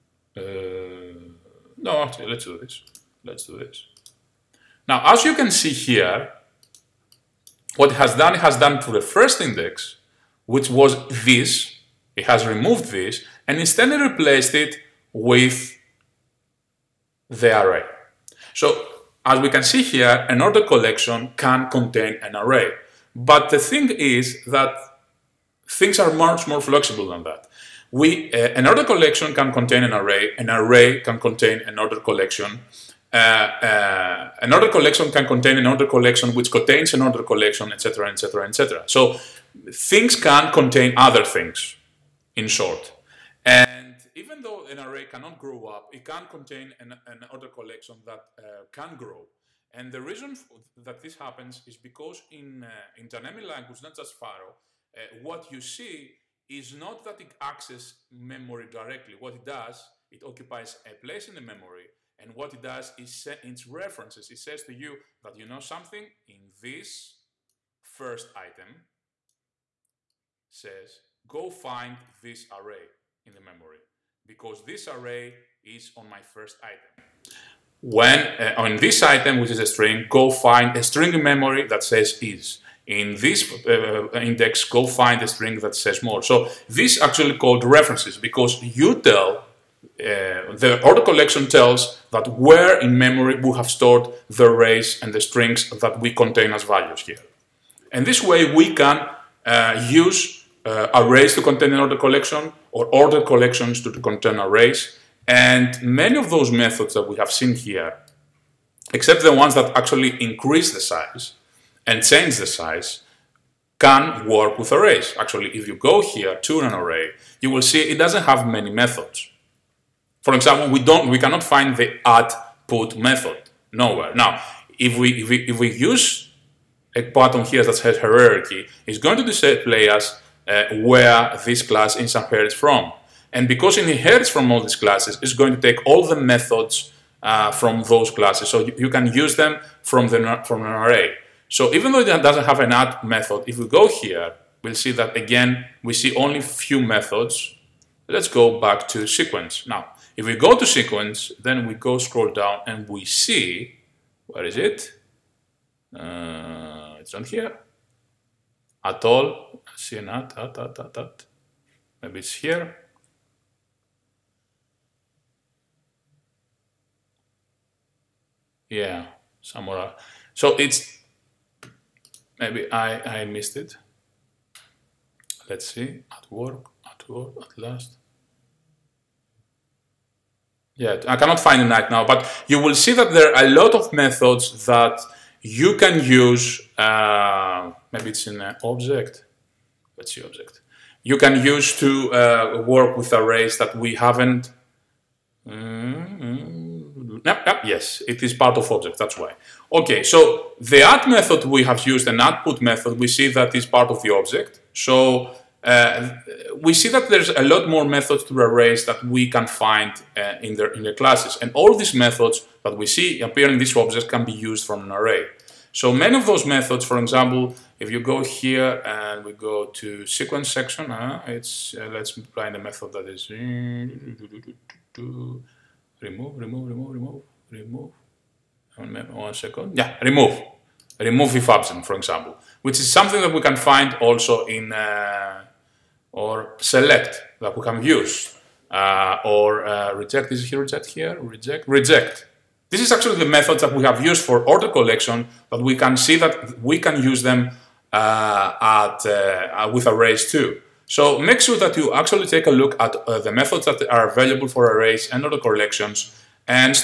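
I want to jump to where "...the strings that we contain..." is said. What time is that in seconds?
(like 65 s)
95 s.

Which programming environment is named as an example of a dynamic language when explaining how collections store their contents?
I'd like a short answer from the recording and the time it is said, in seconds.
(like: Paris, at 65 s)
Pharo, at 54 s.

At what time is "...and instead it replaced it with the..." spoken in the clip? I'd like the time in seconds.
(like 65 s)
13 s.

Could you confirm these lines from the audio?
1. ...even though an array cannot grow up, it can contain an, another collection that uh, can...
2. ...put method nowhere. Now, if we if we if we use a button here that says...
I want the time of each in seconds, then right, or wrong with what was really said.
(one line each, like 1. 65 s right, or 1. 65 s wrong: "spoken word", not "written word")
1. 44 s right
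2. 122 s right.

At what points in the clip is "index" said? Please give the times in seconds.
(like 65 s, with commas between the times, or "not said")
9 s, 84 s.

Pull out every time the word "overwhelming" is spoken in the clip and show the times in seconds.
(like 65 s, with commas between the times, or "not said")
not said.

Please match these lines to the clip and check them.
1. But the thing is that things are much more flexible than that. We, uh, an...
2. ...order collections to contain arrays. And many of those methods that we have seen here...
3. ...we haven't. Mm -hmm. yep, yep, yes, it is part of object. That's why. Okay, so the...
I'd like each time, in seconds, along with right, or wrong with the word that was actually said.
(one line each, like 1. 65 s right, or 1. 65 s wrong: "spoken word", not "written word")
1. 23 s right
2. 102 s right
3. 193 s right.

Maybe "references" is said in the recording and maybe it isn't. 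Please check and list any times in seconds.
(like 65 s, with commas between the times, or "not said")
63 s, 87 s.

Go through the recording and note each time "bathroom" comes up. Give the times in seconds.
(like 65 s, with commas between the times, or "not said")
not said.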